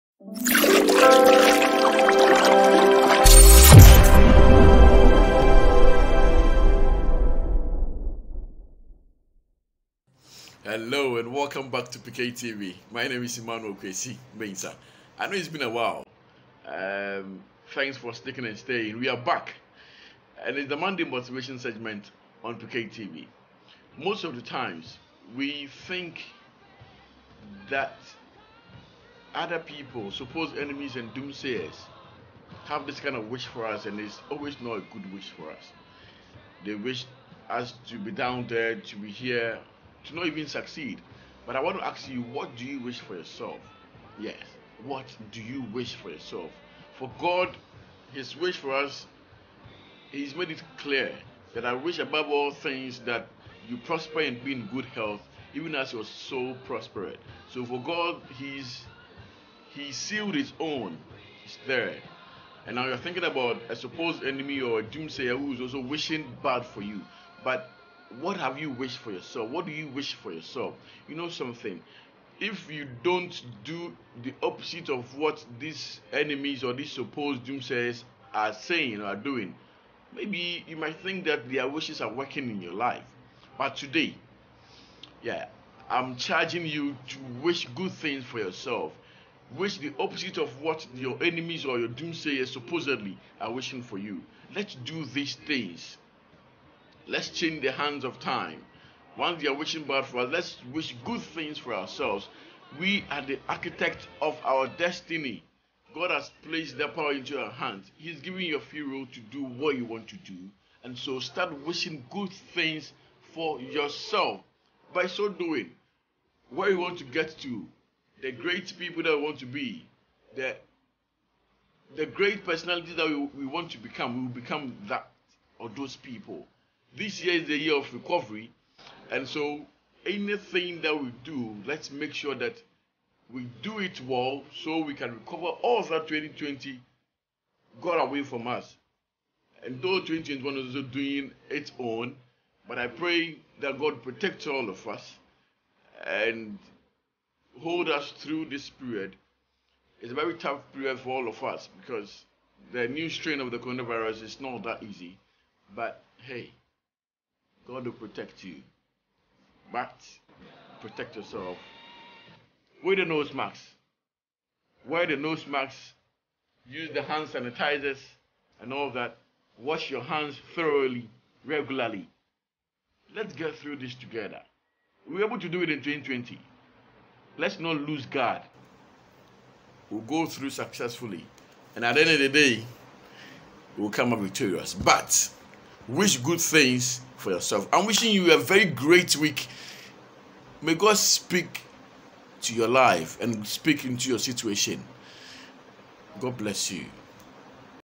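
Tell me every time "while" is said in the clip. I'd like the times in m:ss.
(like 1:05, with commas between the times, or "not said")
0:15.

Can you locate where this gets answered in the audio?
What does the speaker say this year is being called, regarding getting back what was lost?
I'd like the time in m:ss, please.
2:07.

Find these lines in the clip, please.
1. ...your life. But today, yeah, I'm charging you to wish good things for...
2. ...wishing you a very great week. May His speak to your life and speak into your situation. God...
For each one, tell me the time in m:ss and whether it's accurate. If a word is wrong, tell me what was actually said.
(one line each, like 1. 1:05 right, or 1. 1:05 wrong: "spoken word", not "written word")
1. 1:22 right
2. 3:07 wrong: "God", not "His".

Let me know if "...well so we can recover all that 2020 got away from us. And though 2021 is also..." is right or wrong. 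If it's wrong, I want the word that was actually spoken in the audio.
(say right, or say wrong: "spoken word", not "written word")
right.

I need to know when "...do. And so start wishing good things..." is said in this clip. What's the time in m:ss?
1:50.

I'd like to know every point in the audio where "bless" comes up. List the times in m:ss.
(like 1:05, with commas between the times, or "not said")
3:16.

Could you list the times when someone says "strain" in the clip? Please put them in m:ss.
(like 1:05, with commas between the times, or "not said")
2:33.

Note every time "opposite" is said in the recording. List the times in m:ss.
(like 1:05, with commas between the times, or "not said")
1:14, 1:29.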